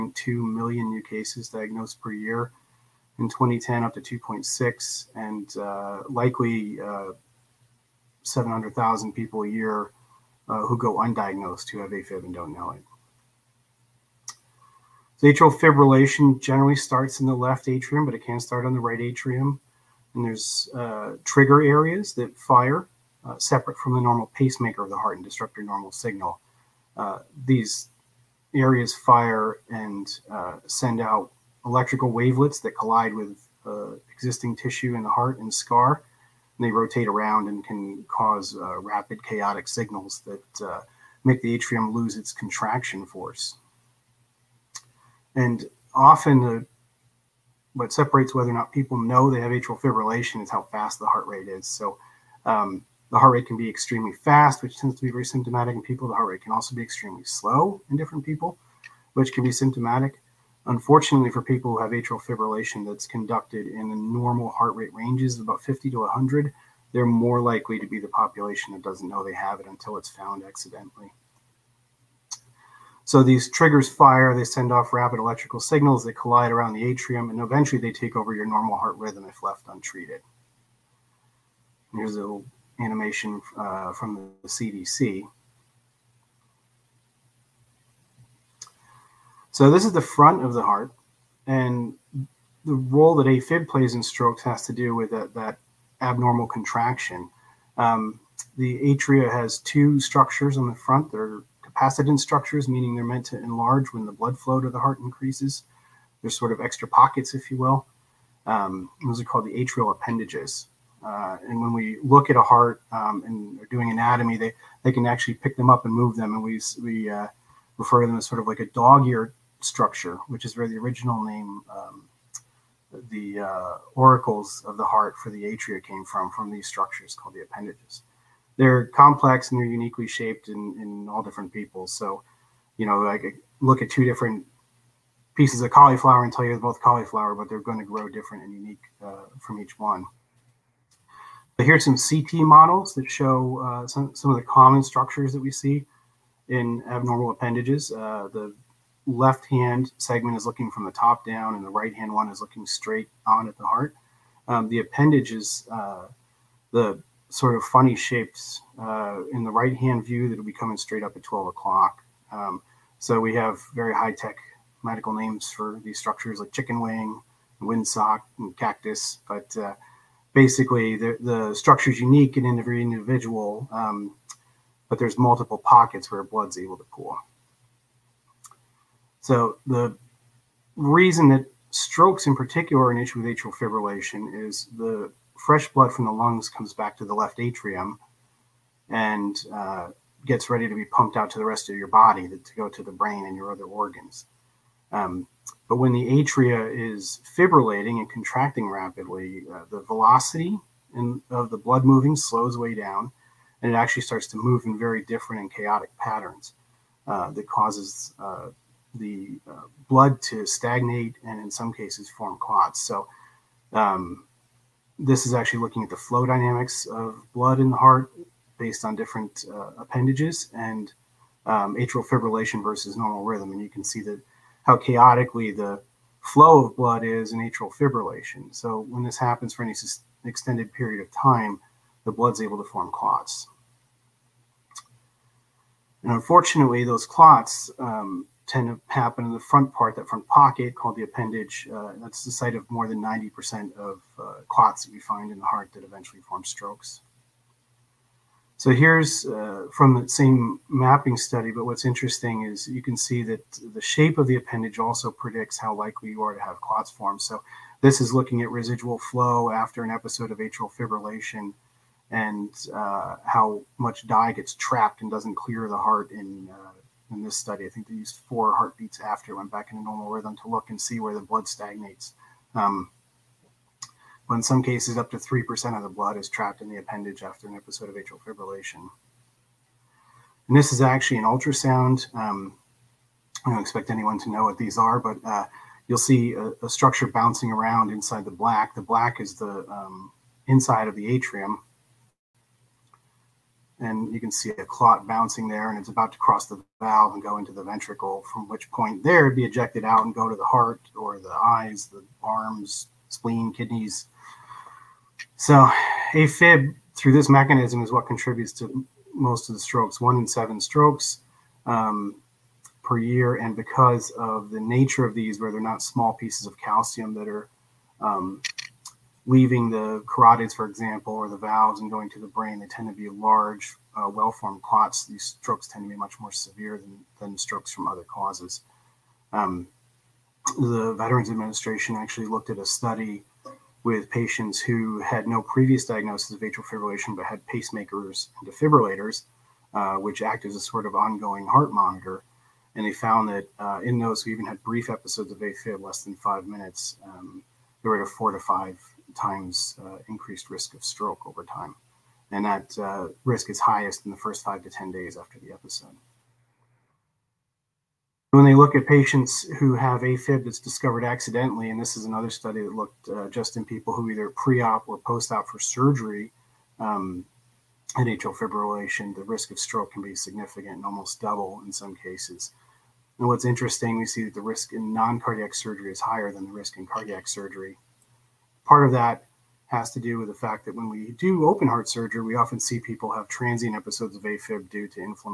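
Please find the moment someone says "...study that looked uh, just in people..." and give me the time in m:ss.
6:02.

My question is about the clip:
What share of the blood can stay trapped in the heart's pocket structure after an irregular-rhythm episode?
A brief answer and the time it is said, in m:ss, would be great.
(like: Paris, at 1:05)
3%, at 4:35.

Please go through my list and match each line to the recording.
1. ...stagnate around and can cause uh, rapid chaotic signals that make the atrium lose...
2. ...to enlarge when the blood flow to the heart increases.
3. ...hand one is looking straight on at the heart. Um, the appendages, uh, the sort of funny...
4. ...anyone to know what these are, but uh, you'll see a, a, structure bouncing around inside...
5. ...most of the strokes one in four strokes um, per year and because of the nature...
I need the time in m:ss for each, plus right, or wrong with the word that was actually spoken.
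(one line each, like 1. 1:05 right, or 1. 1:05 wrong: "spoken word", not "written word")
1. 0:36 wrong: "rotate", not "stagnate"
2. 1:43 right
3. 2:31 right
4. 4:43 right
5. 5:09 wrong: "seven", not "four".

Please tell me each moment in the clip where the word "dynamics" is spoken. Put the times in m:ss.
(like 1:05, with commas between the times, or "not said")
3:36.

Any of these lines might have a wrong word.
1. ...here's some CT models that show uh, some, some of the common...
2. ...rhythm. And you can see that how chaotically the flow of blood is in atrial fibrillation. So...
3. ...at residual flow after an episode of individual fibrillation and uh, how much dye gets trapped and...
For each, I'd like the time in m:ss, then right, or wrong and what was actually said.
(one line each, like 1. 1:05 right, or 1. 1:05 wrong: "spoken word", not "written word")
1. 2:21 right
2. 3:43 right
3. 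4:18 wrong: "atrial", not "individual".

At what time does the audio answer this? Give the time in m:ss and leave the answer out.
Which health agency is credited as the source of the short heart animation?
1:24.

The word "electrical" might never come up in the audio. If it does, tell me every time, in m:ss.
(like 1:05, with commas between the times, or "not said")
0:31, 1:15.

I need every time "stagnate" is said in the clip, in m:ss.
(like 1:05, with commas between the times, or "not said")
3:30, 4:31.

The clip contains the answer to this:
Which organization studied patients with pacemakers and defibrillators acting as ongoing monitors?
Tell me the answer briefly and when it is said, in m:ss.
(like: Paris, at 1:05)
Veterans Administration, at 5:30.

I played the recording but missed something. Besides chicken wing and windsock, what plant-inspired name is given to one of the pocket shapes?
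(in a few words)
cactus.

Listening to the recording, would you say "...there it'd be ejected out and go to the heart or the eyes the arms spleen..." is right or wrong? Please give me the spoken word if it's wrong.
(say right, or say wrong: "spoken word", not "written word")
right.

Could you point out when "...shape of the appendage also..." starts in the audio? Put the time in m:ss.
4:13.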